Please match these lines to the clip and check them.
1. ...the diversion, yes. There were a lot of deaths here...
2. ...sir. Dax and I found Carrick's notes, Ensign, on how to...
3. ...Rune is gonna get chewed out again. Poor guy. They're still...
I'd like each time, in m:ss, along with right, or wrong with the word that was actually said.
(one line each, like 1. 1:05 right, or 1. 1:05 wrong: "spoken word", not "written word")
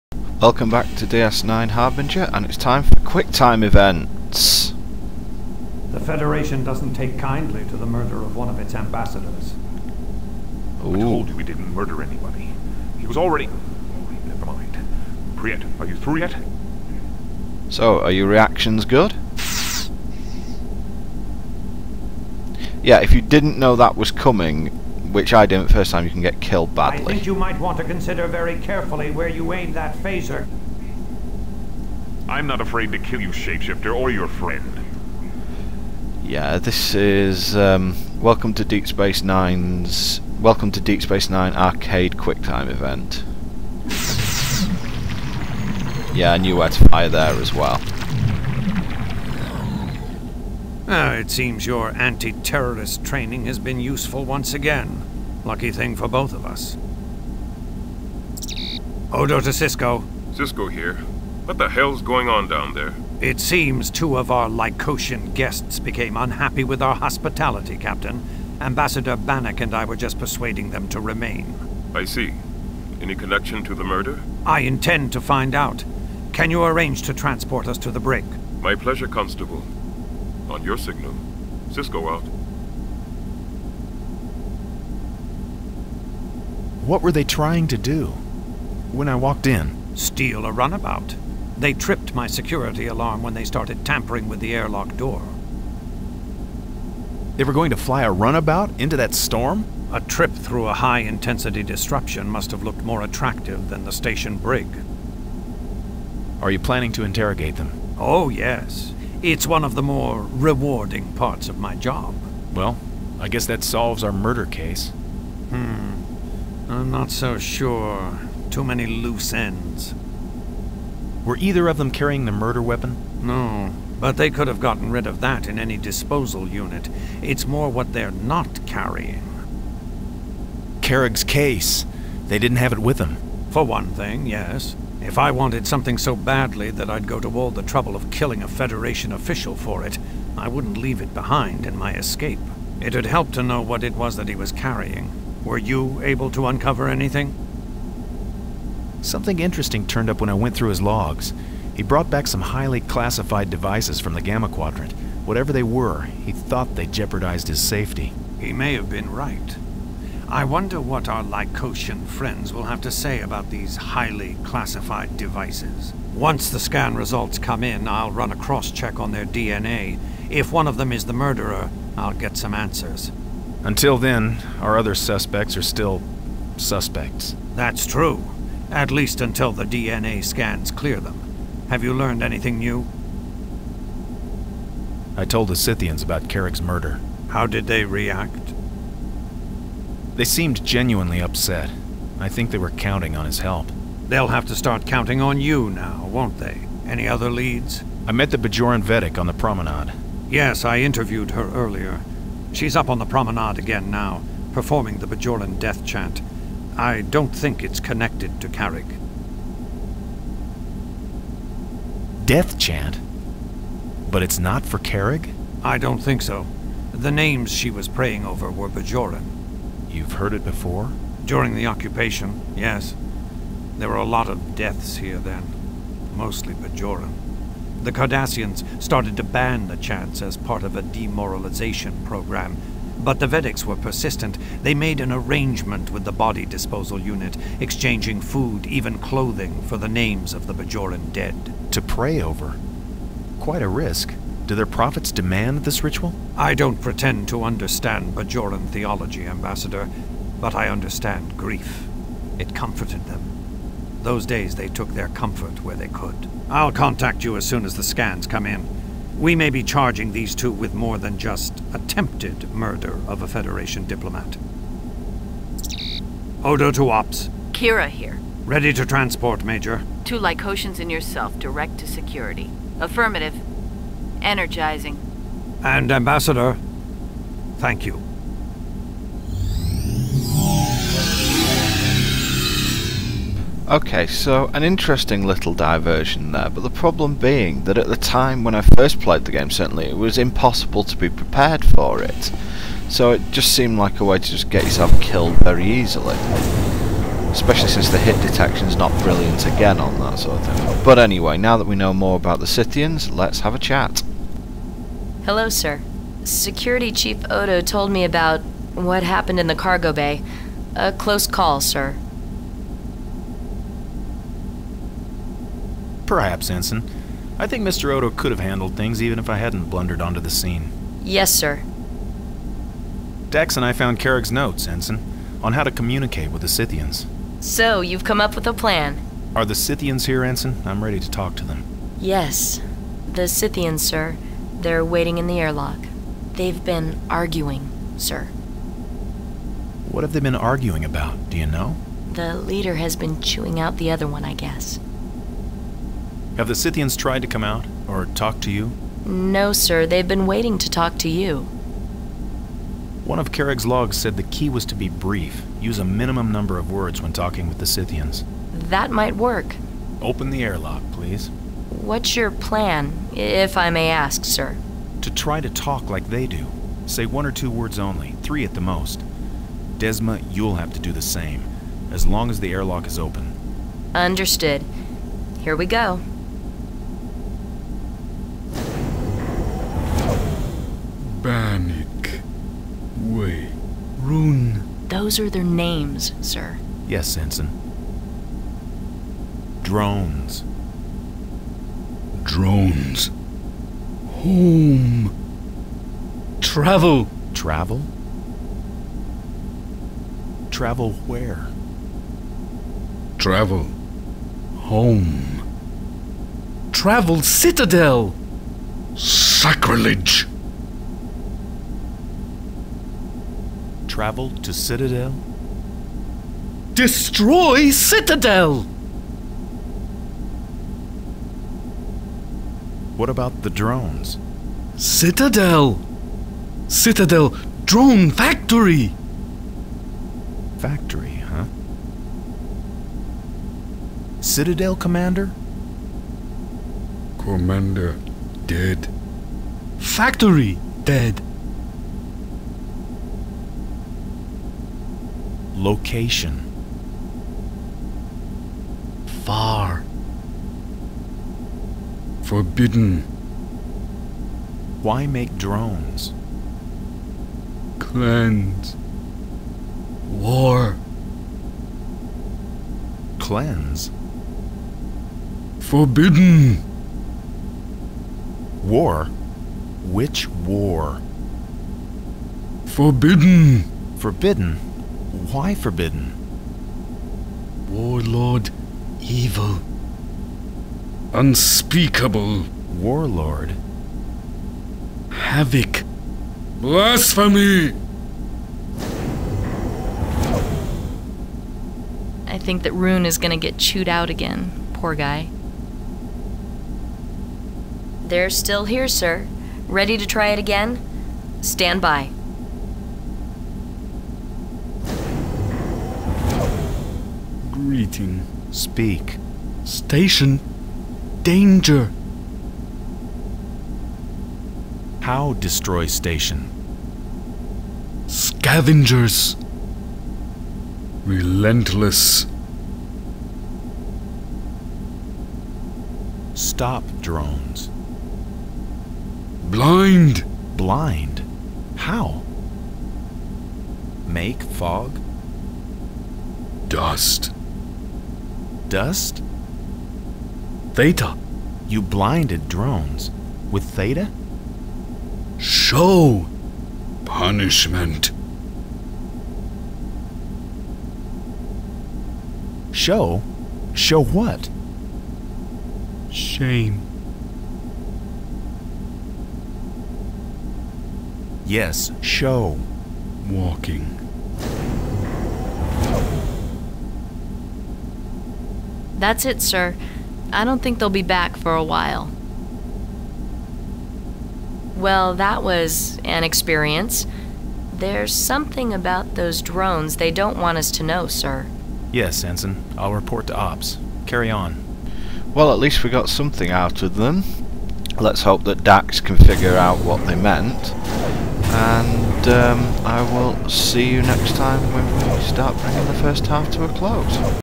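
1. 3:41 wrong: "occupation", not "diversion"
2. 5:21 right
3. 8:12 right.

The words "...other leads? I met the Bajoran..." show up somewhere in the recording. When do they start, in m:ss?
3:17.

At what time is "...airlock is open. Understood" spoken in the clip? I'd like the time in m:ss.
6:12.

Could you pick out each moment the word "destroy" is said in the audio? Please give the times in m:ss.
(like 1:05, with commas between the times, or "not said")
6:56, 8:35.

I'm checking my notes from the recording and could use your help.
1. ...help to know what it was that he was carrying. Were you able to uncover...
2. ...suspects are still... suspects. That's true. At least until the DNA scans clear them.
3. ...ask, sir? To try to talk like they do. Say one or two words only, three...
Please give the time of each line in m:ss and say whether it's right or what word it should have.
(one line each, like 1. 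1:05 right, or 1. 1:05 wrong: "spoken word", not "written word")
1. 2:23 right
2. 2:54 right
3. 6:03 right.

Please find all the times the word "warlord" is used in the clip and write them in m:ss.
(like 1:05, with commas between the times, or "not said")
7:57, 8:02.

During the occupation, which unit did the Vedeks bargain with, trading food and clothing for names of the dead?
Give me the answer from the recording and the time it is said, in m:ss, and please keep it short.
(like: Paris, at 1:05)
Body disposal unit, at 3:56.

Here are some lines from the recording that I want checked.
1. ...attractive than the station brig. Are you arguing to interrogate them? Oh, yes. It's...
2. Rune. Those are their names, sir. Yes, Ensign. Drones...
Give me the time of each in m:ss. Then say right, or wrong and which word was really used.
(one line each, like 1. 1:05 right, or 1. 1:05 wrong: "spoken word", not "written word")
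1. 1:43 wrong: "planning", not "arguing"
2. 6:24 right.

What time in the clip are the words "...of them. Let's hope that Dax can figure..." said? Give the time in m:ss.
9:46.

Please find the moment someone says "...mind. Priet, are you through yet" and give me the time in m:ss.
0:14.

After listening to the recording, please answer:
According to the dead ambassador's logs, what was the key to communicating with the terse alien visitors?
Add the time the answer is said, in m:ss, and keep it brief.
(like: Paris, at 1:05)
Be brief, at 5:54.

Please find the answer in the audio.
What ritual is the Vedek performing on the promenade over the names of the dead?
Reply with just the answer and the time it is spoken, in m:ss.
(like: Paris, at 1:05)
Bajoran death chant, at 3:25.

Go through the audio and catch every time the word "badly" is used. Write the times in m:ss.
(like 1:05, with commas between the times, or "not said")
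0:26, 2:16.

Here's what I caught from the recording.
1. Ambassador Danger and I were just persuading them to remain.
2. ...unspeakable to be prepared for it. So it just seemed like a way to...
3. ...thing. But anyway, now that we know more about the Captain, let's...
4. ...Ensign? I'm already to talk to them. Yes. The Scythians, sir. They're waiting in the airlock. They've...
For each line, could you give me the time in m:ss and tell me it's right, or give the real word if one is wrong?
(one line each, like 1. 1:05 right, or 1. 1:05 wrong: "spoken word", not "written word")
1. 1:08 wrong: "Bannock", not "Danger"
2. 4:50 wrong: "impossible", not "unspeakable"
3. 5:00 wrong: "Scythians", not "Captain"
4. 5:30 wrong: "ready", not "already".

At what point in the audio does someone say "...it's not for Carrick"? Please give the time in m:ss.
3:34.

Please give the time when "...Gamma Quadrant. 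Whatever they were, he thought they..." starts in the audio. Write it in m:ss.
2:34.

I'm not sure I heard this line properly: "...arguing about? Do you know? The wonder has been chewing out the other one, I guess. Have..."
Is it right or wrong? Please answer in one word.
wrong.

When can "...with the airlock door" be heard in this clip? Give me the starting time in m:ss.
1:34.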